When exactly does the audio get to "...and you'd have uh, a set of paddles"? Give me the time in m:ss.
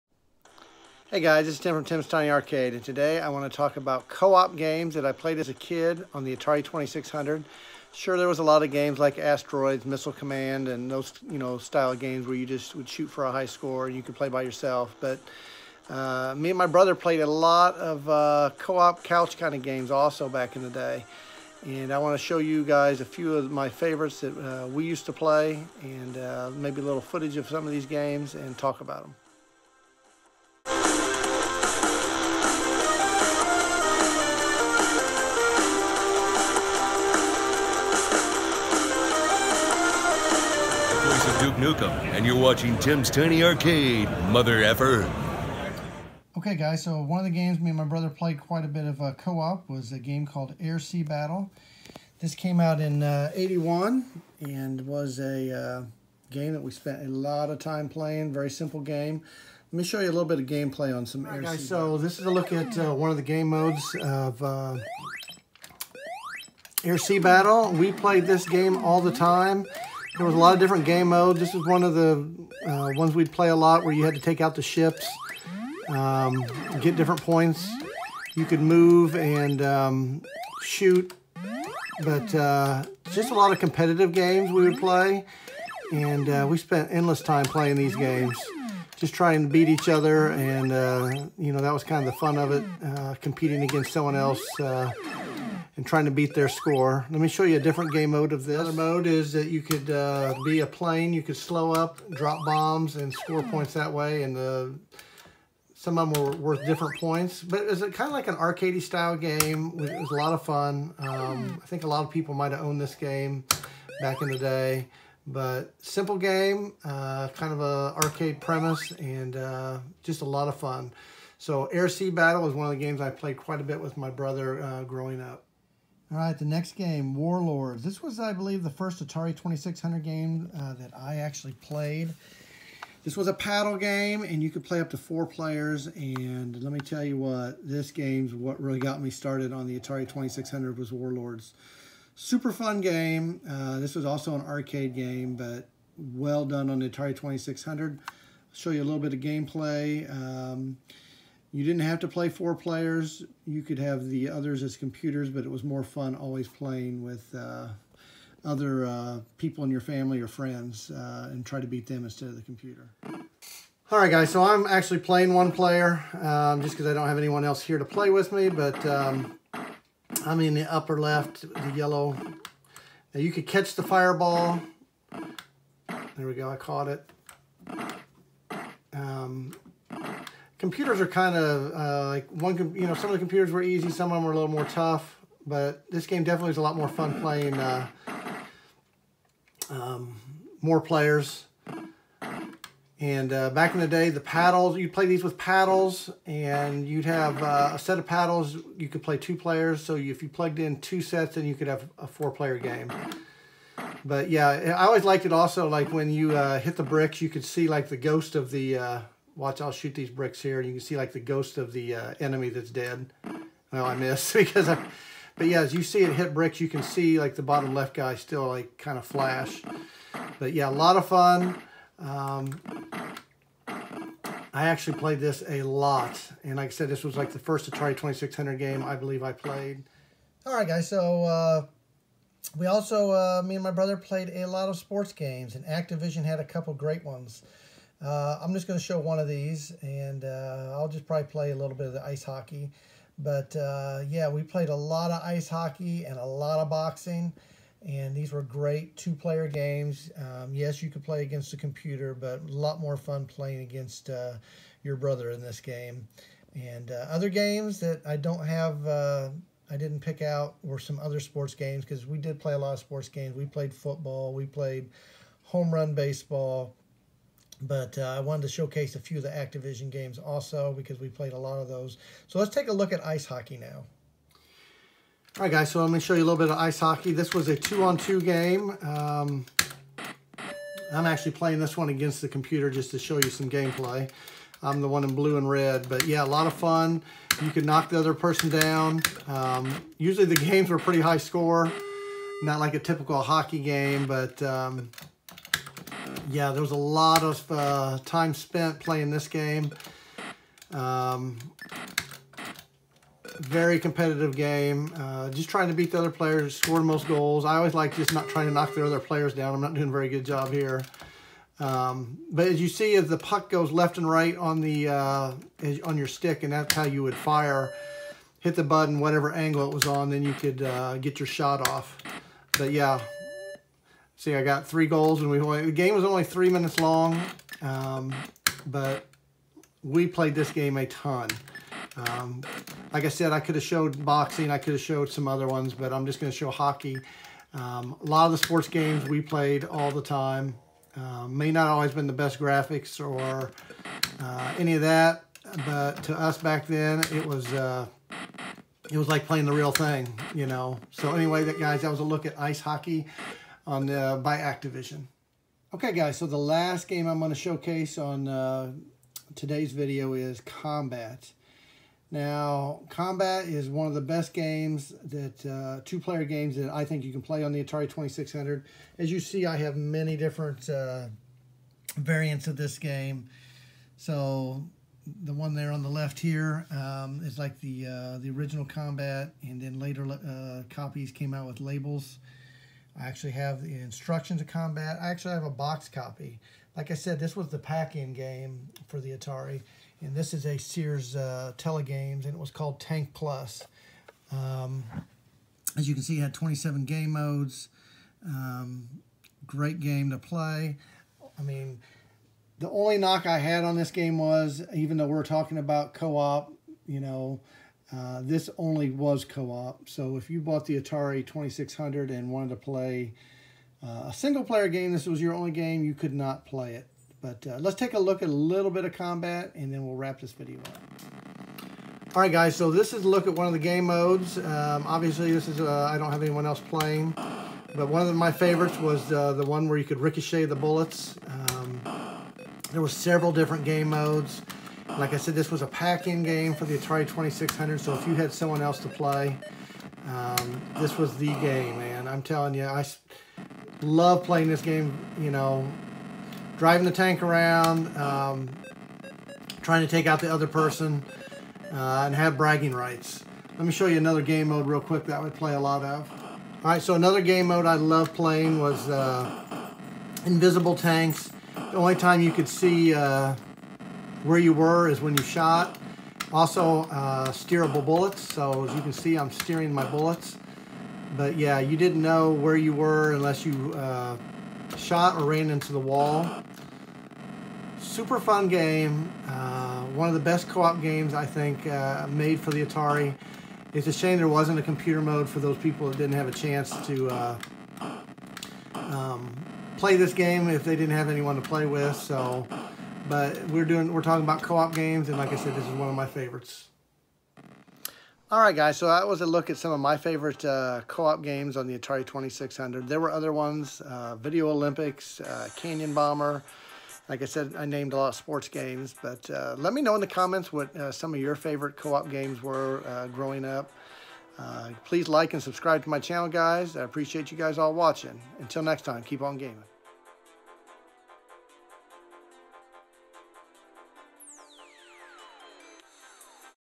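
3:16.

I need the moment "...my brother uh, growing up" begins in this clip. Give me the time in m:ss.
2:03.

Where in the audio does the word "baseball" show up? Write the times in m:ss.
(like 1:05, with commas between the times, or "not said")
4:25.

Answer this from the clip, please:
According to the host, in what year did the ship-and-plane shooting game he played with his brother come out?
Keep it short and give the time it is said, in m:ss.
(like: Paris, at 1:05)
1981, at 0:53.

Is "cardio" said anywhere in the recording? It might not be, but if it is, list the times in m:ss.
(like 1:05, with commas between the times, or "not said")
not said.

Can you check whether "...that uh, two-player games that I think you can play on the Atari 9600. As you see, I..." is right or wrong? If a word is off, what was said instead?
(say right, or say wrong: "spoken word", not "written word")
wrong: "2600", not "9600".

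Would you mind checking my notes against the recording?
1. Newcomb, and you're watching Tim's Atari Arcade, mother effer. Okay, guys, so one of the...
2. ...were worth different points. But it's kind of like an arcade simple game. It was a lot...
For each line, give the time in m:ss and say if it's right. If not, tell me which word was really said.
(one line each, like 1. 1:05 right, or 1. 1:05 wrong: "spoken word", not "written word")
1. 0:41 wrong: "Tiny", not "Atari"
2. 1:46 wrong: "style", not "simple".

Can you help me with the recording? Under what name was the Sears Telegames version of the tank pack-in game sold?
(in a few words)
Tank Plus.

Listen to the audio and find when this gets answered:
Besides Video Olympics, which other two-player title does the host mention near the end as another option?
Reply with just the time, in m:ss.
8:25.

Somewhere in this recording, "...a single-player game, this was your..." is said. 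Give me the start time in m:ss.
6:54.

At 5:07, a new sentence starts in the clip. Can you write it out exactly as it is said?
I always like just not trying to knock the other players down.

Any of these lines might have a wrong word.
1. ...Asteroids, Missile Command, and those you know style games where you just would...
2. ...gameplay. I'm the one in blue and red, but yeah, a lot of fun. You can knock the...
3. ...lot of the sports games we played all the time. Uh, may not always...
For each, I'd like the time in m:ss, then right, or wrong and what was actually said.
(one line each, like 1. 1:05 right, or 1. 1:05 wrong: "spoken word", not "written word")
1. 0:09 right
2. 4:43 right
3. 5:38 right.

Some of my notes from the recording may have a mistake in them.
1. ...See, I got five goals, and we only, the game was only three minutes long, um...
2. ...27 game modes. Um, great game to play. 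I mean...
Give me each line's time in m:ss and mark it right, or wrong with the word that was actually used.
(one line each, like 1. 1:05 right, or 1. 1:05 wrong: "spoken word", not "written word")
1. 5:24 wrong: "three", not "five"
2. 6:36 right.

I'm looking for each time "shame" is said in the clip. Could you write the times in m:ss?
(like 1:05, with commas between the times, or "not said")
8:03.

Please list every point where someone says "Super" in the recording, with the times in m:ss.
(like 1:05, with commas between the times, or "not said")
2:22, 7:57.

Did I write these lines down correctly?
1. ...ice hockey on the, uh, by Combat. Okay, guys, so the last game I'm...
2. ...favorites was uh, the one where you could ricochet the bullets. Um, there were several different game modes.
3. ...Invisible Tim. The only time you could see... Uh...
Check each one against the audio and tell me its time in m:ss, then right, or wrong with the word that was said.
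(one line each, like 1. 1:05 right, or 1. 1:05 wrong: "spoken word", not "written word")
1. 5:52 wrong: "Activision", not "Combat"
2. 7:08 right
3. 7:40 wrong: "Tanks", not "Tim".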